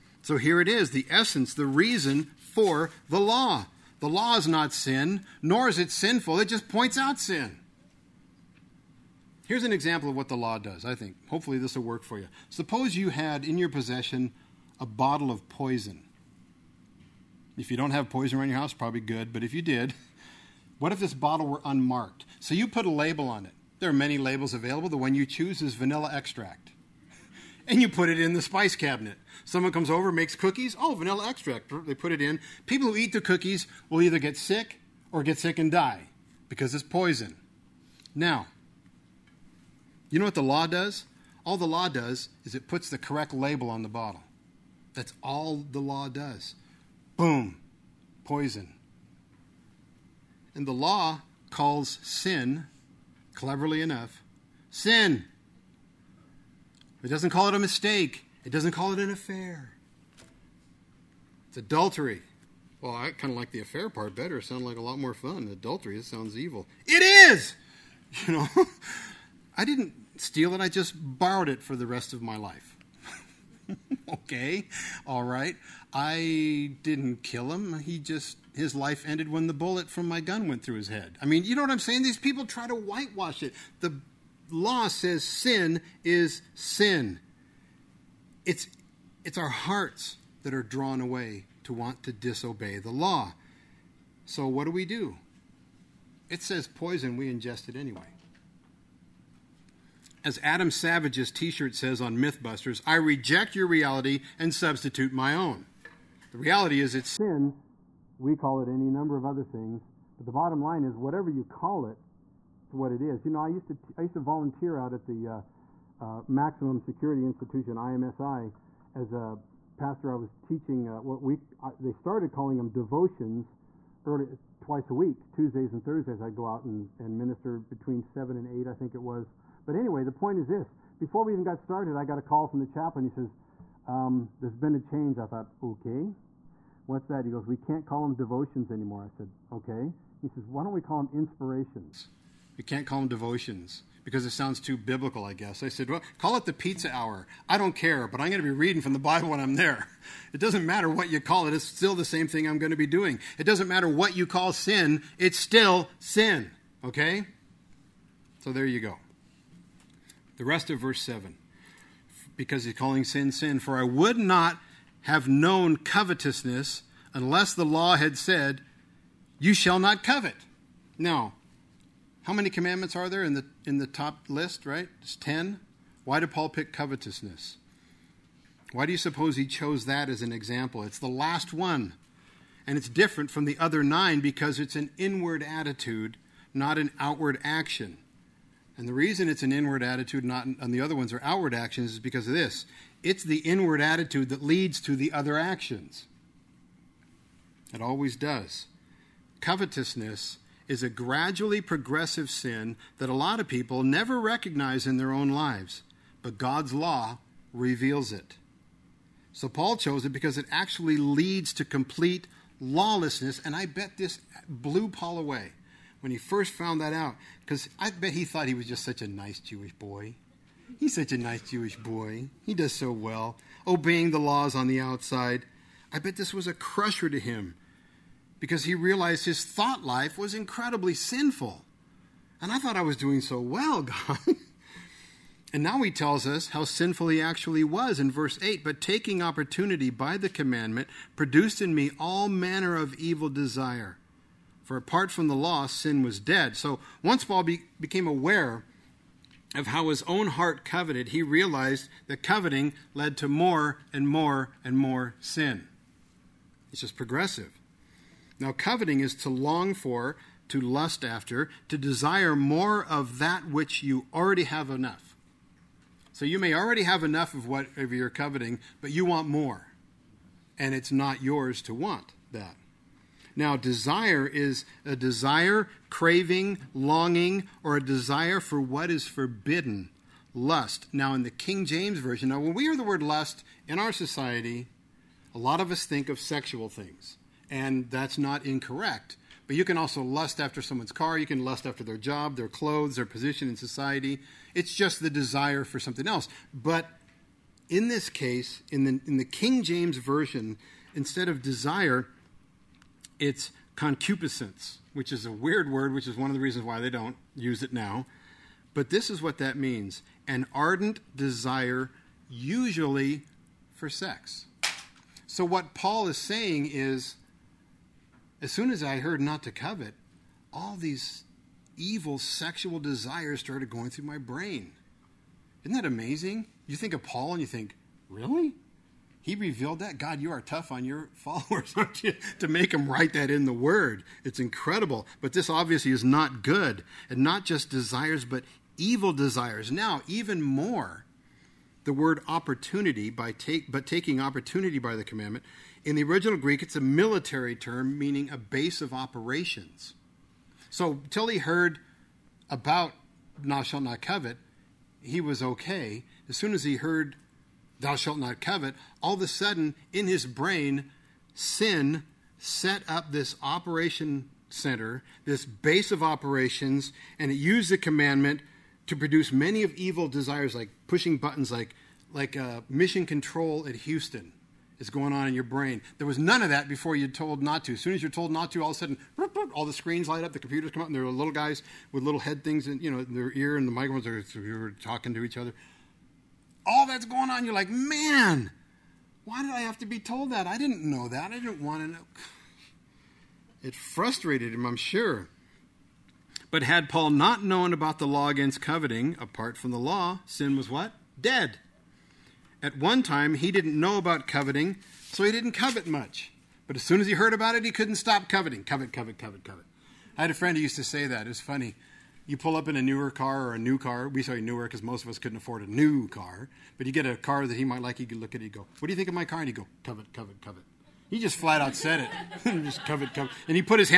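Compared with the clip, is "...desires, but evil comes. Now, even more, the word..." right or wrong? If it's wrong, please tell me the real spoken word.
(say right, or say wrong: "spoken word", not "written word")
wrong: "desires", not "comes".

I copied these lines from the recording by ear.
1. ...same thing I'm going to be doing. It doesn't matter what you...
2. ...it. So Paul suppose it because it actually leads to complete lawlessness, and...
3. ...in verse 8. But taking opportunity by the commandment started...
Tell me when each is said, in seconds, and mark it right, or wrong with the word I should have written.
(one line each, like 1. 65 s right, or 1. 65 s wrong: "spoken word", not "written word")
1. 152 s right
2. 208 s wrong: "chose", not "suppose"
3. 237 s wrong: "produced", not "started".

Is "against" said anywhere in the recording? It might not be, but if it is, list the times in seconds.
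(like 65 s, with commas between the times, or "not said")
398 s.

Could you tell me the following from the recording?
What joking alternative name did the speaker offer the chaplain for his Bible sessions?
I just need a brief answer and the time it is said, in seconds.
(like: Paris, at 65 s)
the pizza hour, at 146 s.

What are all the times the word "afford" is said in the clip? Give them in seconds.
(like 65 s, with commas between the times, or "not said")
415 s.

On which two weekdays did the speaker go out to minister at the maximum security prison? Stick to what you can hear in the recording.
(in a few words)
Tuesdays and Thursdays.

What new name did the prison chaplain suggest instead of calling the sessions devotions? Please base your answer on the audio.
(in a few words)
inspirations.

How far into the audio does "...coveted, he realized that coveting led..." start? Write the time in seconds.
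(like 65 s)
250 s.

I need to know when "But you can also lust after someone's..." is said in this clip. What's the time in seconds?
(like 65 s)
289 s.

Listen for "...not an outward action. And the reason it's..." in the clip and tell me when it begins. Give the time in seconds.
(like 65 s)
186 s.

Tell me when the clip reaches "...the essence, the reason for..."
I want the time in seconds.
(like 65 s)
0 s.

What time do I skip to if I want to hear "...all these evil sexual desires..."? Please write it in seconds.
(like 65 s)
320 s.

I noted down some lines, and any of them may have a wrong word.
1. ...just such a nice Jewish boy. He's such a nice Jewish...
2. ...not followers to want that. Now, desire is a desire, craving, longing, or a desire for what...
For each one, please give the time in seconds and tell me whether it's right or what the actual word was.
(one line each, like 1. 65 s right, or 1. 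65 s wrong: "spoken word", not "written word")
1. 218 s right
2. 270 s wrong: "yours", not "followers".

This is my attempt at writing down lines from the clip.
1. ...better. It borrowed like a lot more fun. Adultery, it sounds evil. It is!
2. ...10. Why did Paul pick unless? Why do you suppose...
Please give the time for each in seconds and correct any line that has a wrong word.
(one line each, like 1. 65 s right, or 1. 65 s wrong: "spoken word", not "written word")
1. 64 s wrong: "sounded", not "borrowed"
2. 175 s wrong: "covetousness", not "unless".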